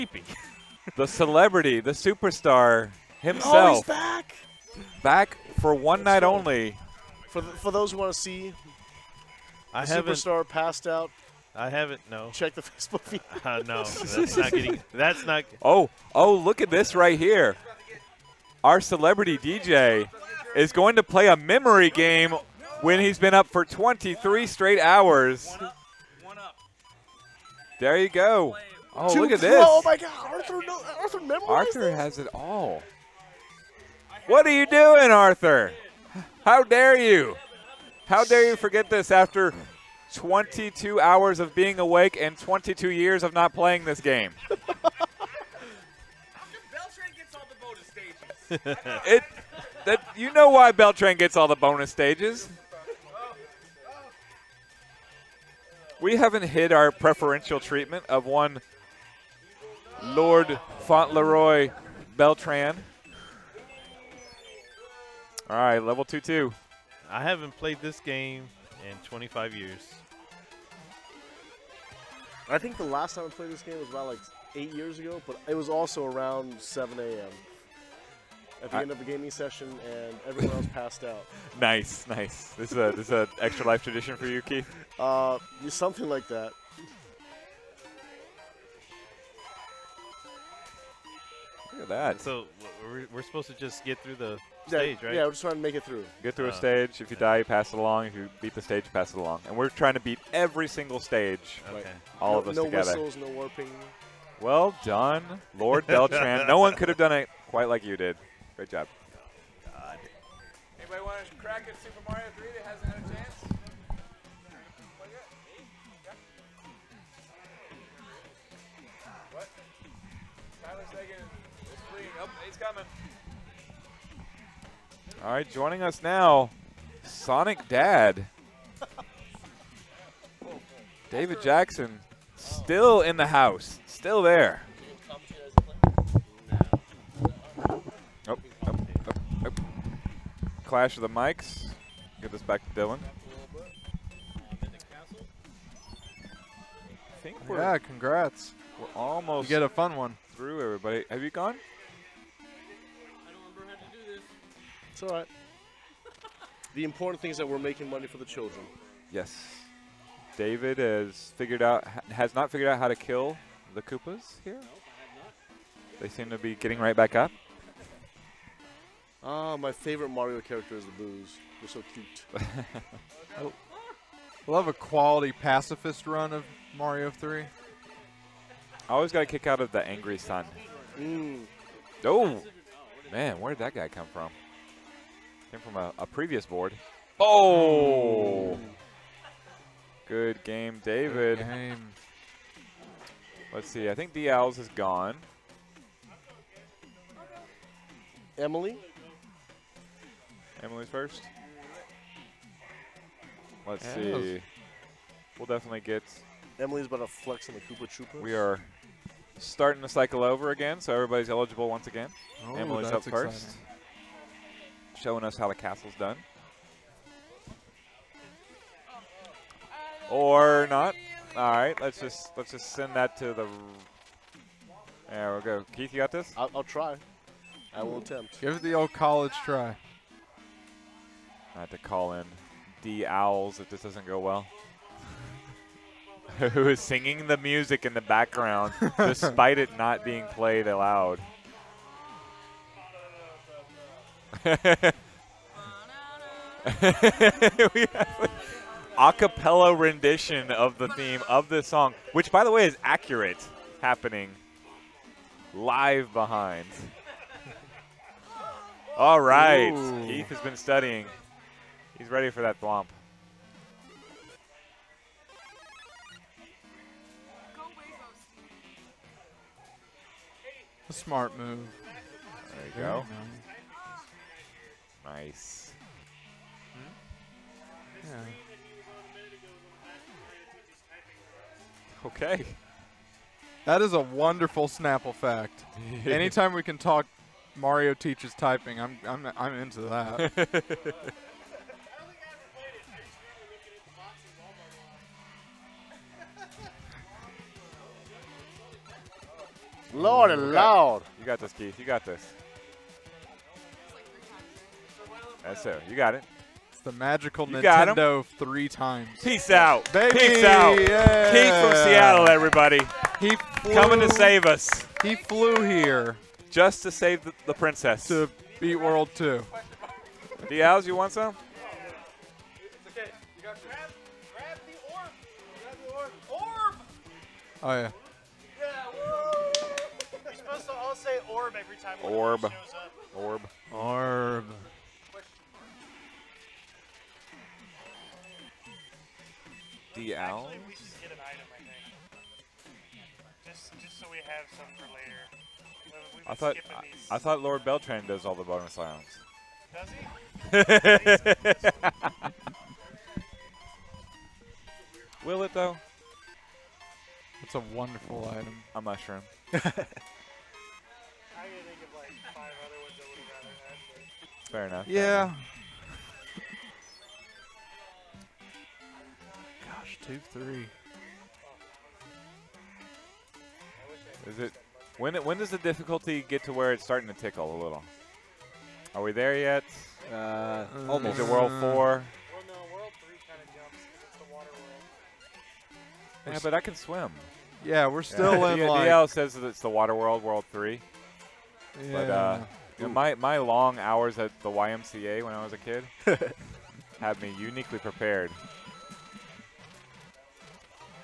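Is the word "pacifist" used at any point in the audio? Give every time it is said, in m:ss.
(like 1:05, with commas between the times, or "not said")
2:55.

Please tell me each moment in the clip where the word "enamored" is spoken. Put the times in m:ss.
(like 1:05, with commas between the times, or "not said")
not said.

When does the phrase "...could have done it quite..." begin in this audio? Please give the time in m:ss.
1:46.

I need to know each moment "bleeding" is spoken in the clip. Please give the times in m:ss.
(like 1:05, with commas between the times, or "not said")
2:01.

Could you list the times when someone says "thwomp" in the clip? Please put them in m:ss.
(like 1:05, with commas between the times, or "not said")
4:22.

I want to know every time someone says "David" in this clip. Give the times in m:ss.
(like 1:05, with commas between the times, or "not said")
2:11, 2:40, 3:10.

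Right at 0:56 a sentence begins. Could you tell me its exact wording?
We haven't hid our preferential treatment of one Lord Fauntleroy Beltran.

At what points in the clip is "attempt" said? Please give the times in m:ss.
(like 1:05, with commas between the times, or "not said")
3:47.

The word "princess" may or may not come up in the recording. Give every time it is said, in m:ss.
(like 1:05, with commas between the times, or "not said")
5:17.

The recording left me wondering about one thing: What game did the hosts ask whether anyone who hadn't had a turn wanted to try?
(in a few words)
Super Mario 3.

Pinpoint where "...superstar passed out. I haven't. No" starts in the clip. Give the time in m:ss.
0:10.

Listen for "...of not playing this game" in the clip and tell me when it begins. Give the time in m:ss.
0:43.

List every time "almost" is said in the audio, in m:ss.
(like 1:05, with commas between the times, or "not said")
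2:28, 6:20.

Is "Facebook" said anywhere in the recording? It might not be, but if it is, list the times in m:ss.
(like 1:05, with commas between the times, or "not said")
0:12.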